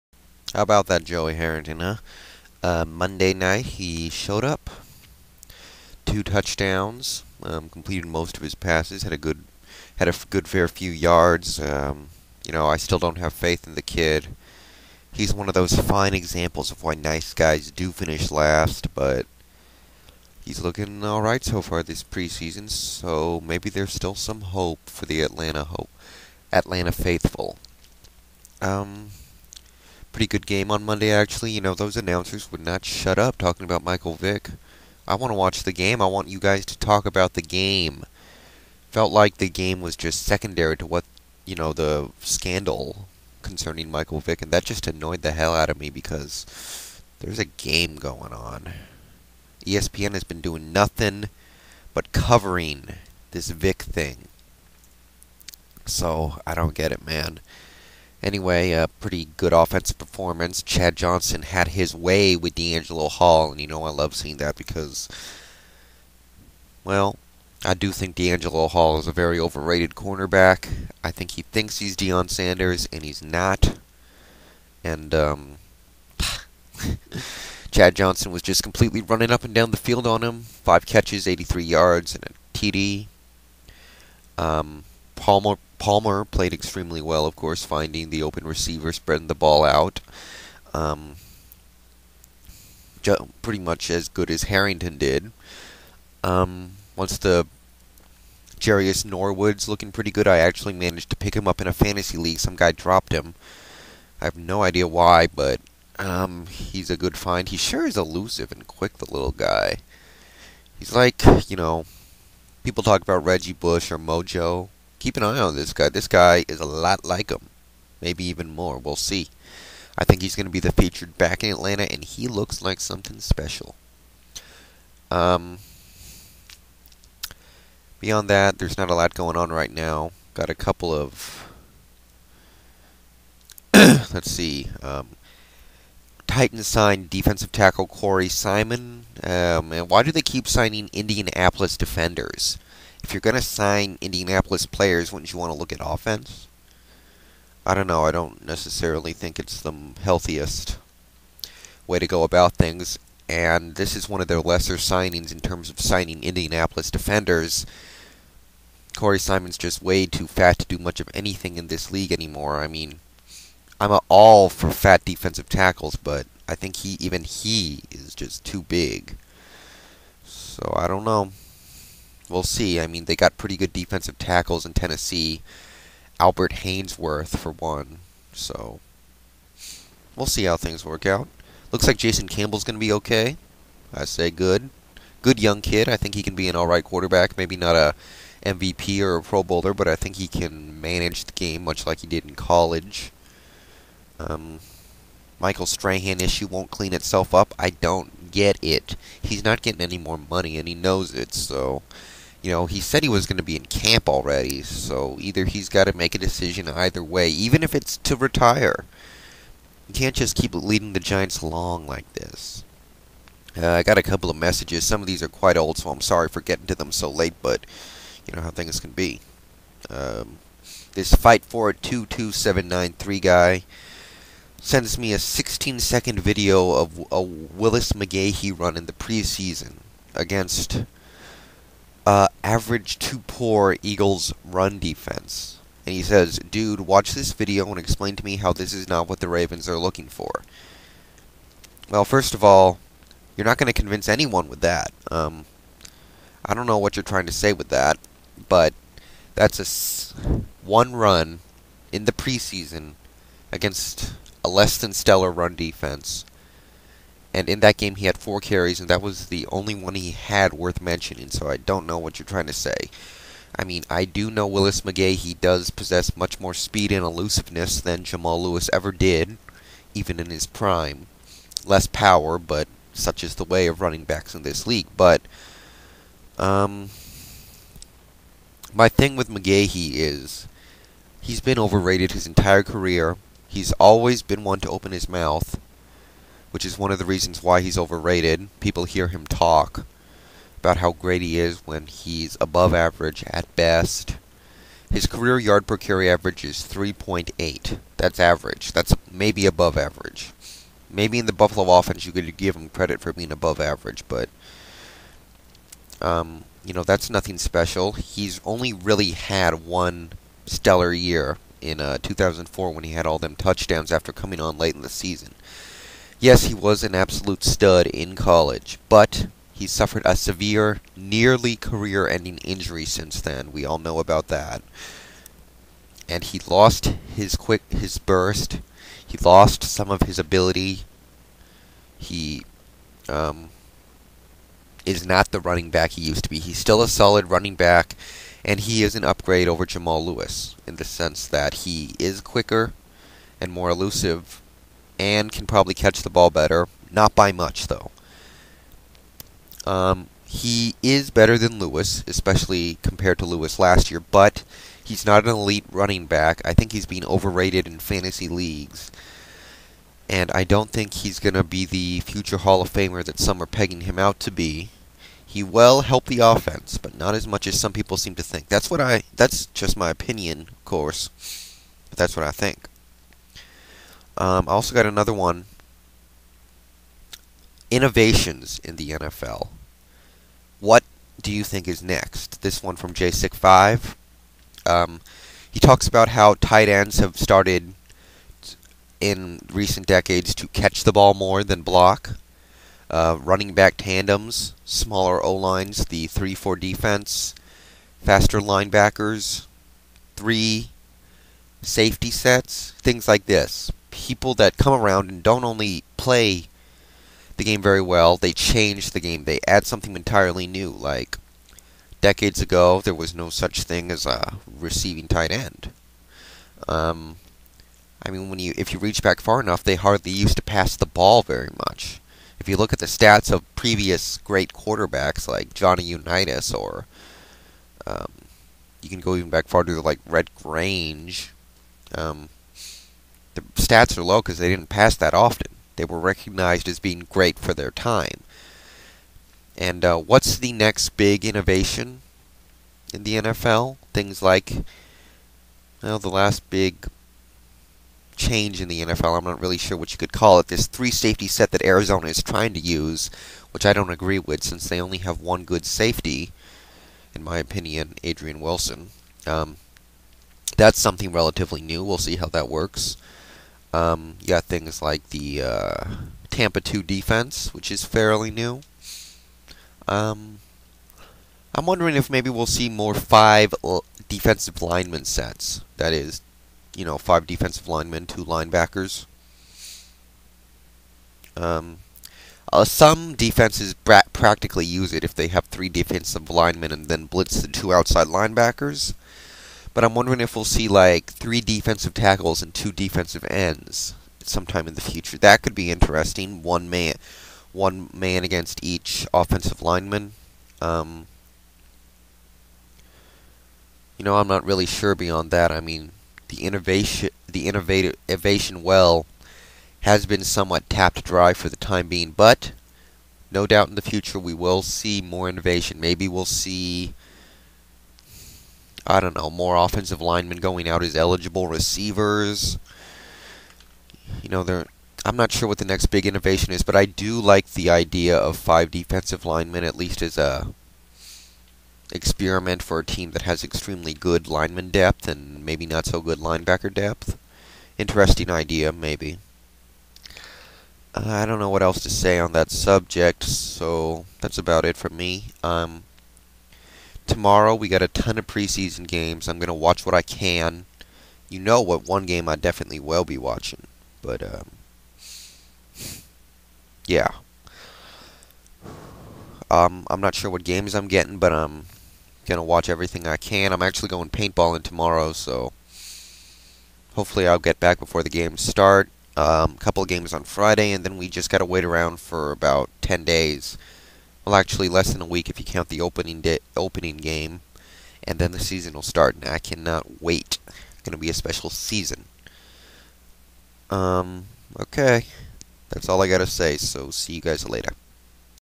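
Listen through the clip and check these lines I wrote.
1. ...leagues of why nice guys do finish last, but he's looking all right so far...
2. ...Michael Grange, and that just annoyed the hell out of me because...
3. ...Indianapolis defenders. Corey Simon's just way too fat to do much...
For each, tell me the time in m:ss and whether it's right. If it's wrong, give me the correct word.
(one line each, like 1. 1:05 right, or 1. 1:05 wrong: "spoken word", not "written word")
1. 0:16 wrong: "examples", not "leagues"
2. 0:43 wrong: "Vick", not "Grange"
3. 2:36 right.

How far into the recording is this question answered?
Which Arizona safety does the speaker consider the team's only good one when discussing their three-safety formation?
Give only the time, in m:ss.
7:38.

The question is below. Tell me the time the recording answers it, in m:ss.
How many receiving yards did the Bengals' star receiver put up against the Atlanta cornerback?
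1:21.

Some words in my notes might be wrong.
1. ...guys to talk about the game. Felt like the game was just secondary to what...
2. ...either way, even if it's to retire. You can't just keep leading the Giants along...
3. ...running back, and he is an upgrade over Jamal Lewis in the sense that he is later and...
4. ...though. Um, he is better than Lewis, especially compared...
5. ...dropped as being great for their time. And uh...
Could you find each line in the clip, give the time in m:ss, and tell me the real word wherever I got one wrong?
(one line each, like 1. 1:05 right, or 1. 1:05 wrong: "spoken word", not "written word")
1. 0:36 right
2. 3:26 right
3. 5:37 wrong: "quicker", not "later"
4. 5:47 right
5. 7:15 wrong: "recognized", not "dropped".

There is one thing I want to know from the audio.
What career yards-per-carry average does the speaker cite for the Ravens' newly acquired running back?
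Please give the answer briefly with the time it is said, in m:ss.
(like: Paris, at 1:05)
3.8, at 4:56.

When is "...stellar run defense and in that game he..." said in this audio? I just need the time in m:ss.
4:14.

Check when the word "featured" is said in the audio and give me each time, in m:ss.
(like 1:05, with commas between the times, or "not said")
2:00.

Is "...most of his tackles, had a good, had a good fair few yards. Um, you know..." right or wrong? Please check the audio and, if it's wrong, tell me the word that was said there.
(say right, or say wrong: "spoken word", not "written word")
wrong: "passes", not "tackles".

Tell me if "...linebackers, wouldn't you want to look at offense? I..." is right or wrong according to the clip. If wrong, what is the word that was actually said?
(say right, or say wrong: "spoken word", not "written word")
wrong: "players", not "linebackers".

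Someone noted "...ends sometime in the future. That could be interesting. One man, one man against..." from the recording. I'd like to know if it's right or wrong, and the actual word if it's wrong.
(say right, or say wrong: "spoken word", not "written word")
right.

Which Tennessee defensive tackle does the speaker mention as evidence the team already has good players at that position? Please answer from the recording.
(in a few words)
Albert Haynesworth.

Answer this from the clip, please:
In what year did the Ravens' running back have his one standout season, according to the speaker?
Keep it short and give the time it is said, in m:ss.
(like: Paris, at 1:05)
2004, at 5:12.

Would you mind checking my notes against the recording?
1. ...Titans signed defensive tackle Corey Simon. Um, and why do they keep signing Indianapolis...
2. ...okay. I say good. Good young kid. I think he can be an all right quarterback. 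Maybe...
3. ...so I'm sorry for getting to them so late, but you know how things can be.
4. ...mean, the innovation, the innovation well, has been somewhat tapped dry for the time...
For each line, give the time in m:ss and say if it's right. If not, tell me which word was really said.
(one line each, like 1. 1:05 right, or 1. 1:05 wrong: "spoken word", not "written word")
1. 2:16 right
2. 3:02 right
3. 3:35 right
4. 8:25 right.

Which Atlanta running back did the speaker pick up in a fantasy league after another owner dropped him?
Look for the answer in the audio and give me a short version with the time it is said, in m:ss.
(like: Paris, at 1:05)
Jerious Norwood, at 1:38.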